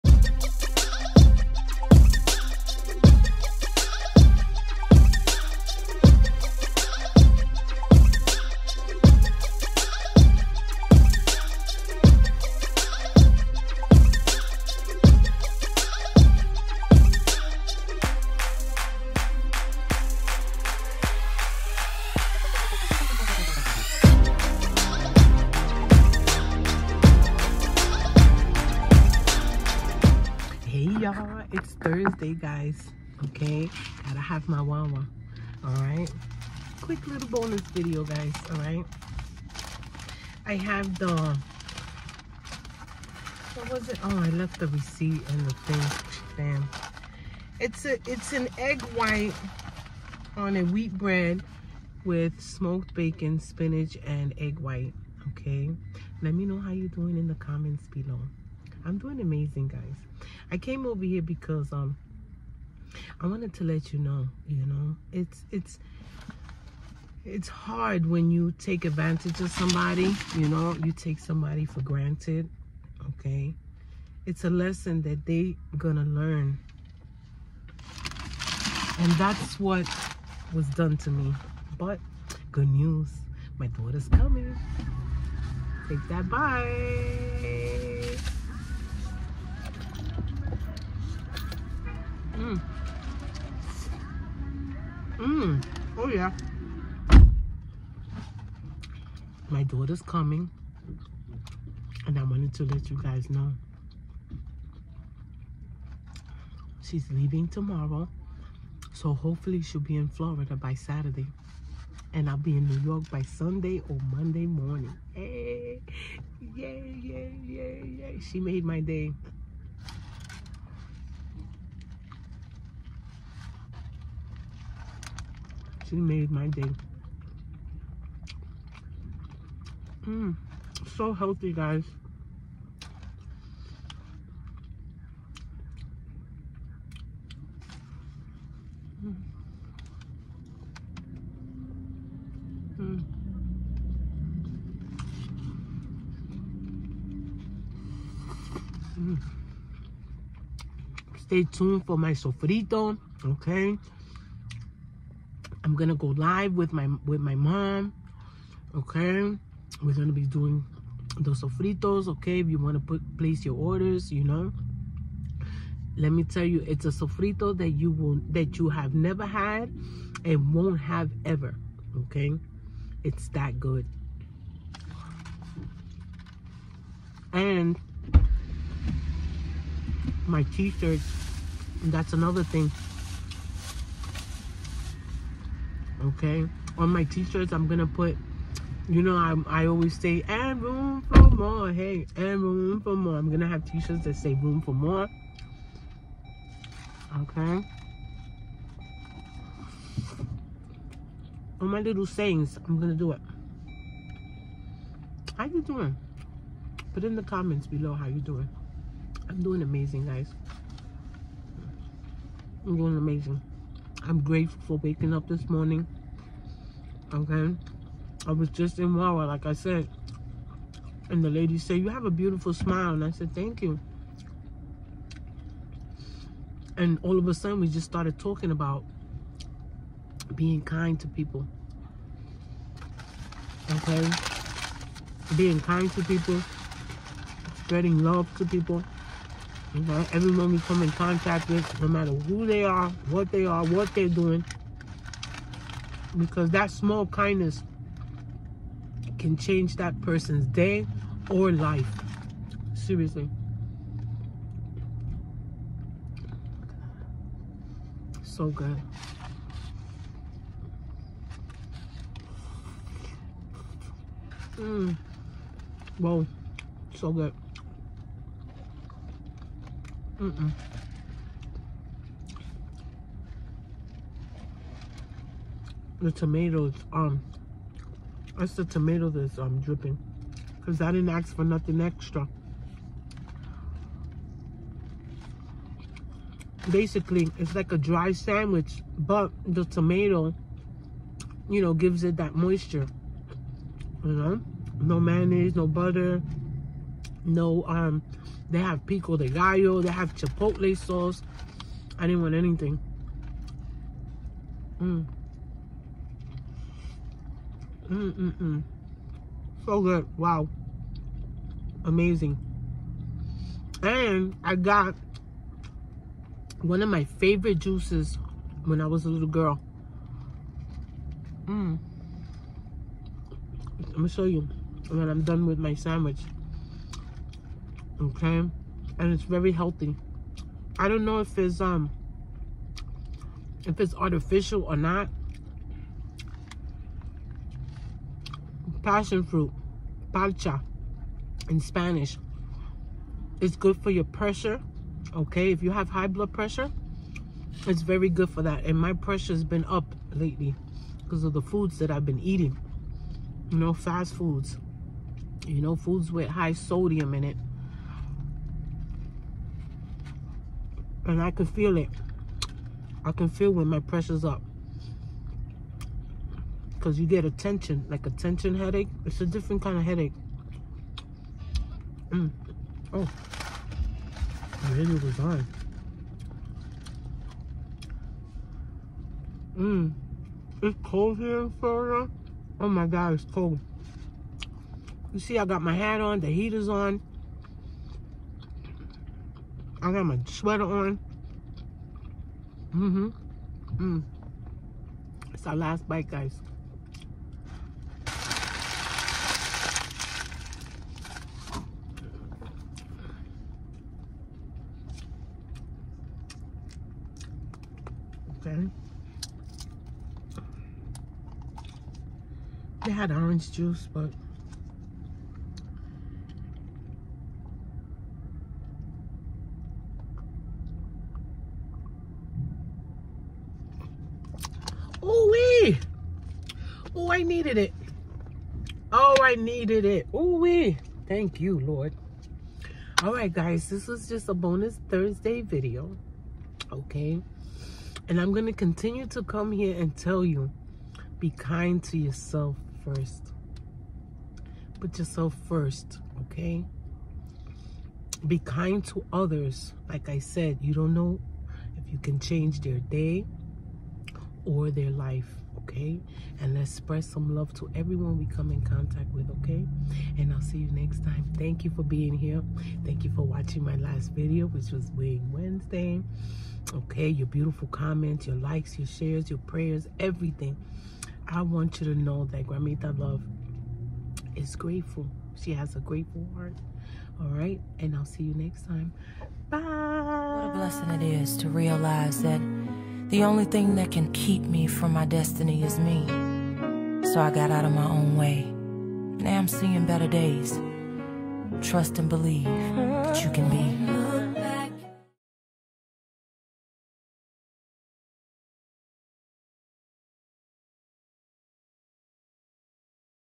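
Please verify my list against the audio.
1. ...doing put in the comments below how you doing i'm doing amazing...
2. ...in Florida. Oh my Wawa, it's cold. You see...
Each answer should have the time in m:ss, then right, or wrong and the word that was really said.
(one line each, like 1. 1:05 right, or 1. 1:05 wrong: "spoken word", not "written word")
1. 3:25 right
2. 6:21 wrong: "God", not "Wawa".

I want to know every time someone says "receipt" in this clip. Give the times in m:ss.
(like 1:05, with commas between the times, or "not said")
0:44.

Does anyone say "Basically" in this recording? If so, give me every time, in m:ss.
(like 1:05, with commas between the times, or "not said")
4:46.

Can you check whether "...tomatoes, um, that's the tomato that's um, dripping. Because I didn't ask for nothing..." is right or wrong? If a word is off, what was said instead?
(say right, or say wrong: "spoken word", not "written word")
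right.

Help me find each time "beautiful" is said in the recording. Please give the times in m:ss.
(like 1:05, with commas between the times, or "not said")
3:42, 7:47.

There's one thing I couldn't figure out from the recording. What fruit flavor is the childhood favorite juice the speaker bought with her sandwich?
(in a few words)
passion fruit.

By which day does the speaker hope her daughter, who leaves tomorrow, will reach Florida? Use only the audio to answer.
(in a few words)
Saturday.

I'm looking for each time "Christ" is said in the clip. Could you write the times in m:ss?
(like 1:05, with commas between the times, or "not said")
not said.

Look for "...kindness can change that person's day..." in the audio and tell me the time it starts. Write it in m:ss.
4:07.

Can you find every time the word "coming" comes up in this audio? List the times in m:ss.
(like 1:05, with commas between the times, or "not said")
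1:24, 1:40.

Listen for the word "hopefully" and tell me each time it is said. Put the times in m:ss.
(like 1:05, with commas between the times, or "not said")
1:49.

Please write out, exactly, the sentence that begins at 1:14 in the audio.
It's a lesson that they gonna learn.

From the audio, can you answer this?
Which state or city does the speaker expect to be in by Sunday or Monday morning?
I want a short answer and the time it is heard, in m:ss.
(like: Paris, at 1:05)
New York, at 1:52.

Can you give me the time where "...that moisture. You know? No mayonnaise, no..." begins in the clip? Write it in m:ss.
4:52.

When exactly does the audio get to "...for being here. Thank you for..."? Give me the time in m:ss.
7:41.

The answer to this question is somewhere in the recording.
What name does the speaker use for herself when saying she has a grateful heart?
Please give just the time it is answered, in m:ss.
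7:52.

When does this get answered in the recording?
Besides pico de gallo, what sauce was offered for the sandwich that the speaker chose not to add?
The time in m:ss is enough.
5:00.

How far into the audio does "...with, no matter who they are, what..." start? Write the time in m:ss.
4:01.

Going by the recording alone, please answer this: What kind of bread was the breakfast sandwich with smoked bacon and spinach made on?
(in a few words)
wheat bread.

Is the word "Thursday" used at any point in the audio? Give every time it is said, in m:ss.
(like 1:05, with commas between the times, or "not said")
0:31, 7:14.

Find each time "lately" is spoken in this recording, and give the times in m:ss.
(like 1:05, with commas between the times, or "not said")
5:50.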